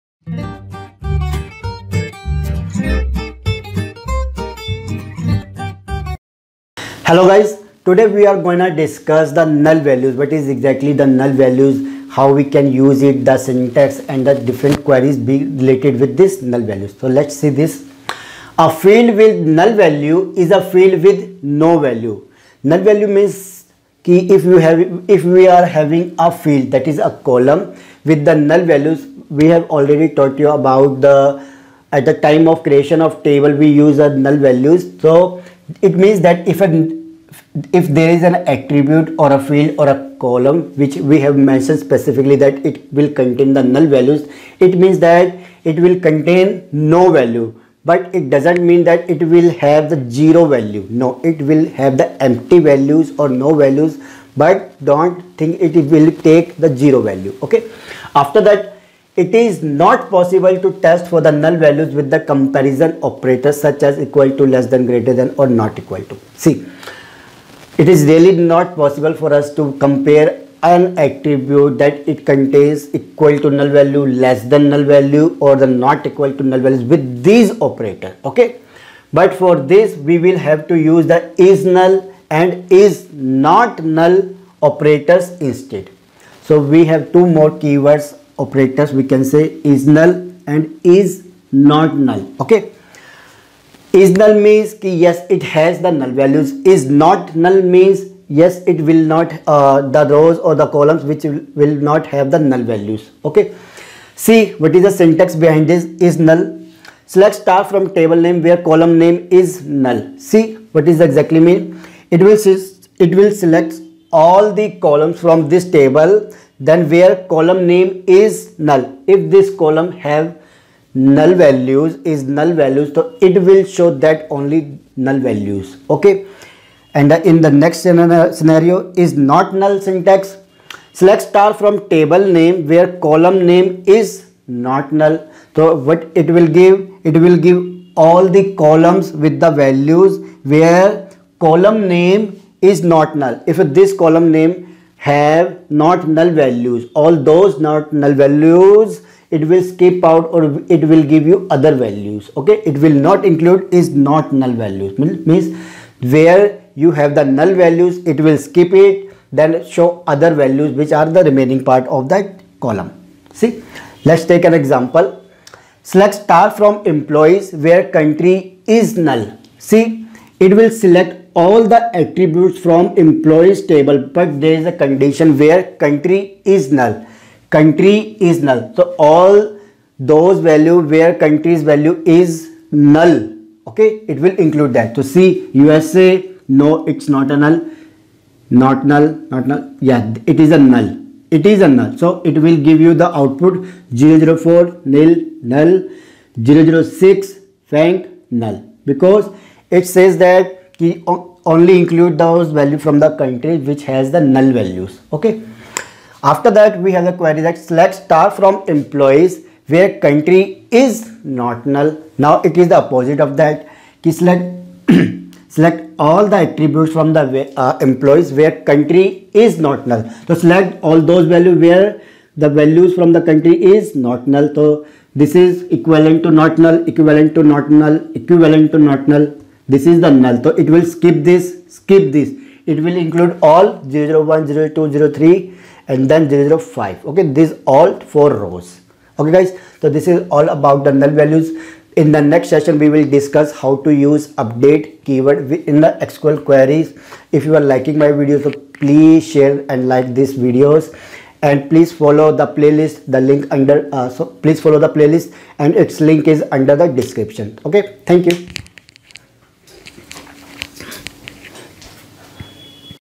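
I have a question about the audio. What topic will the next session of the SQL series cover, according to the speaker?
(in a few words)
update keyword.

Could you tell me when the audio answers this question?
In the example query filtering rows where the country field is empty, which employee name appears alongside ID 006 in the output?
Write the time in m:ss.
3:17.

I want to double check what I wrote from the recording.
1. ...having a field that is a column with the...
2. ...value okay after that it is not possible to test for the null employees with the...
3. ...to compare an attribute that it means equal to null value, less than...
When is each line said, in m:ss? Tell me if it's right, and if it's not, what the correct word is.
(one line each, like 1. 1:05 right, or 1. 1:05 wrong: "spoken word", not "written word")
1. 0:25 right
2. 0:57 wrong: "values", not "employees"
3. 1:09 wrong: "contains", not "means".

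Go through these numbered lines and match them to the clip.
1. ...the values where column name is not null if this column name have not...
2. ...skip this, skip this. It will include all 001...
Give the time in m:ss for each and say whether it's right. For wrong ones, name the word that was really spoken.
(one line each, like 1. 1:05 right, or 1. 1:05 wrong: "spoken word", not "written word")
1. 2:19 right
2. 3:50 right.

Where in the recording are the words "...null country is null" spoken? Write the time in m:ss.
2:56.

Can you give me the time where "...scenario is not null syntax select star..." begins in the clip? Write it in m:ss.
2:07.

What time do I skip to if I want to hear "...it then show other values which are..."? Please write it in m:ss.
2:38.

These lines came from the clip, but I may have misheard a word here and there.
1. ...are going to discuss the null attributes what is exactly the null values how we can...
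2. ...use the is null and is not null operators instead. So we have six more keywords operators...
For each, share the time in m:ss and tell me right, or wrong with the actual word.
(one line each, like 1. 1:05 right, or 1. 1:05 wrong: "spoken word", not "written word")
1. 0:08 wrong: "values", not "attributes"
2. 1:20 wrong: "two", not "six".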